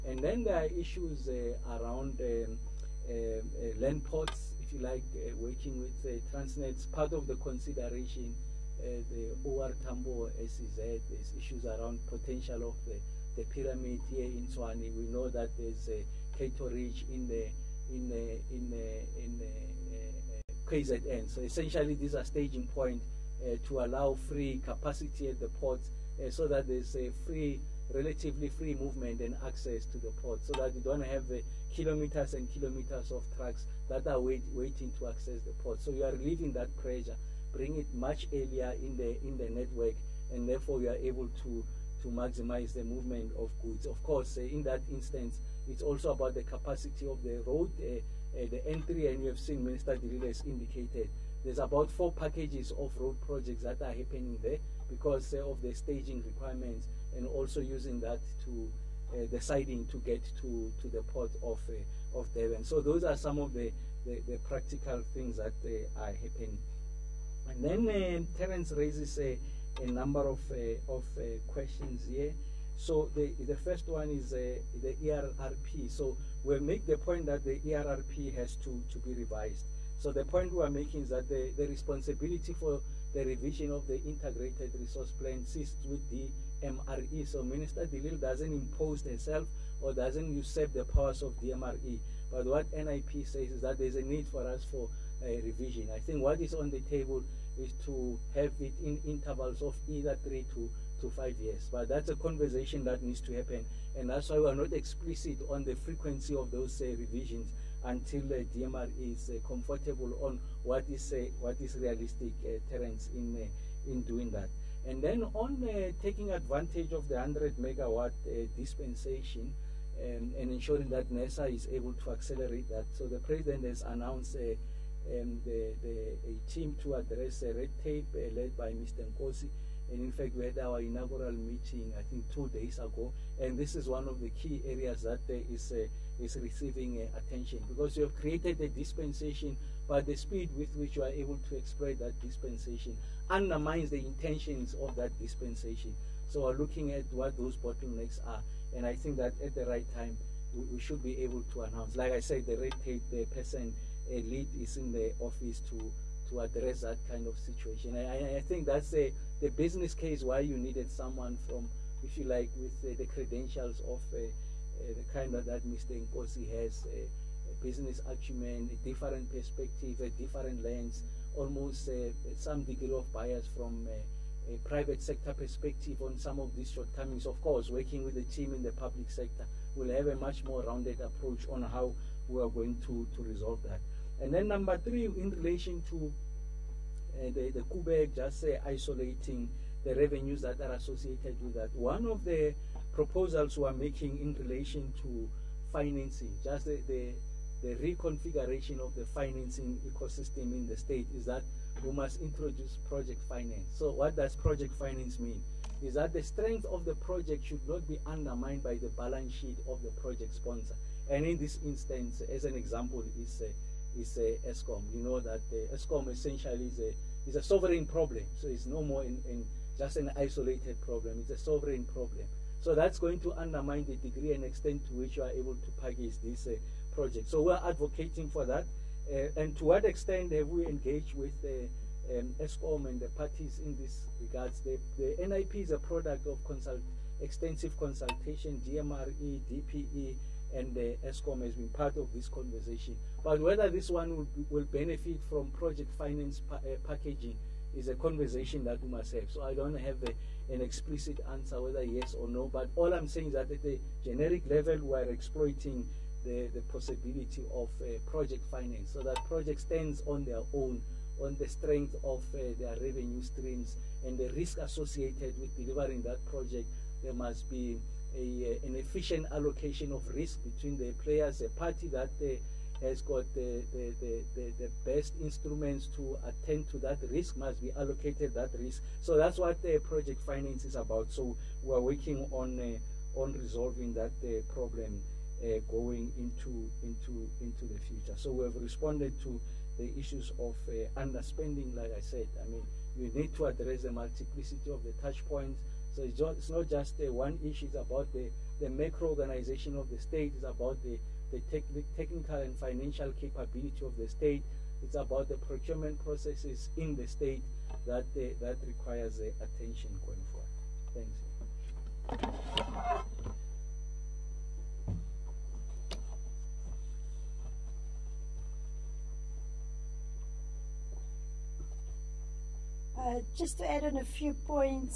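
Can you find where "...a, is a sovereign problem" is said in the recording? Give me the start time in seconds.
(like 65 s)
216 s.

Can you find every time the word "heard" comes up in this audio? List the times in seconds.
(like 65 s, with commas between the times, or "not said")
not said.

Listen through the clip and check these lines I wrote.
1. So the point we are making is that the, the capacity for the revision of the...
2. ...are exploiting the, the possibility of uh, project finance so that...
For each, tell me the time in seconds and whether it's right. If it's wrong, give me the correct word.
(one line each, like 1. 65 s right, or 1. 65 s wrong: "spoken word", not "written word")
1. 79 s wrong: "responsibility", not "capacity"
2. 254 s right.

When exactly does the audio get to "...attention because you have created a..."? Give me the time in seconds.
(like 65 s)
137 s.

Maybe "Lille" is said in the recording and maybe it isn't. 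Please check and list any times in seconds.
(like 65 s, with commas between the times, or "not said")
50 s, 87 s.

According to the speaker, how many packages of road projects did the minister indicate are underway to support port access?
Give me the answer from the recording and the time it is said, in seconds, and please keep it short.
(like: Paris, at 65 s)
4, at 51 s.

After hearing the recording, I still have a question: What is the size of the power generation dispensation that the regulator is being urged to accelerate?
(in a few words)
100 megawatt.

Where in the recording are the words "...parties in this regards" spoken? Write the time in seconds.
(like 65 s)
233 s.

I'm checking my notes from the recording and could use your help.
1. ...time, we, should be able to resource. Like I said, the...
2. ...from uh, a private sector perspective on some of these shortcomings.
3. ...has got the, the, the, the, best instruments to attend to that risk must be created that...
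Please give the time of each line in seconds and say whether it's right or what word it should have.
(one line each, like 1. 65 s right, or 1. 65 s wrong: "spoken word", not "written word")
1. 149 s wrong: "announce", not "resource"
2. 173 s right
3. 272 s wrong: "allocated", not "created".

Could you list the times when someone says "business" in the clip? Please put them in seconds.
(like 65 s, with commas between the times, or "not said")
159 s, 167 s.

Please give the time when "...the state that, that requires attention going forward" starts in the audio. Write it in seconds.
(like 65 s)
306 s.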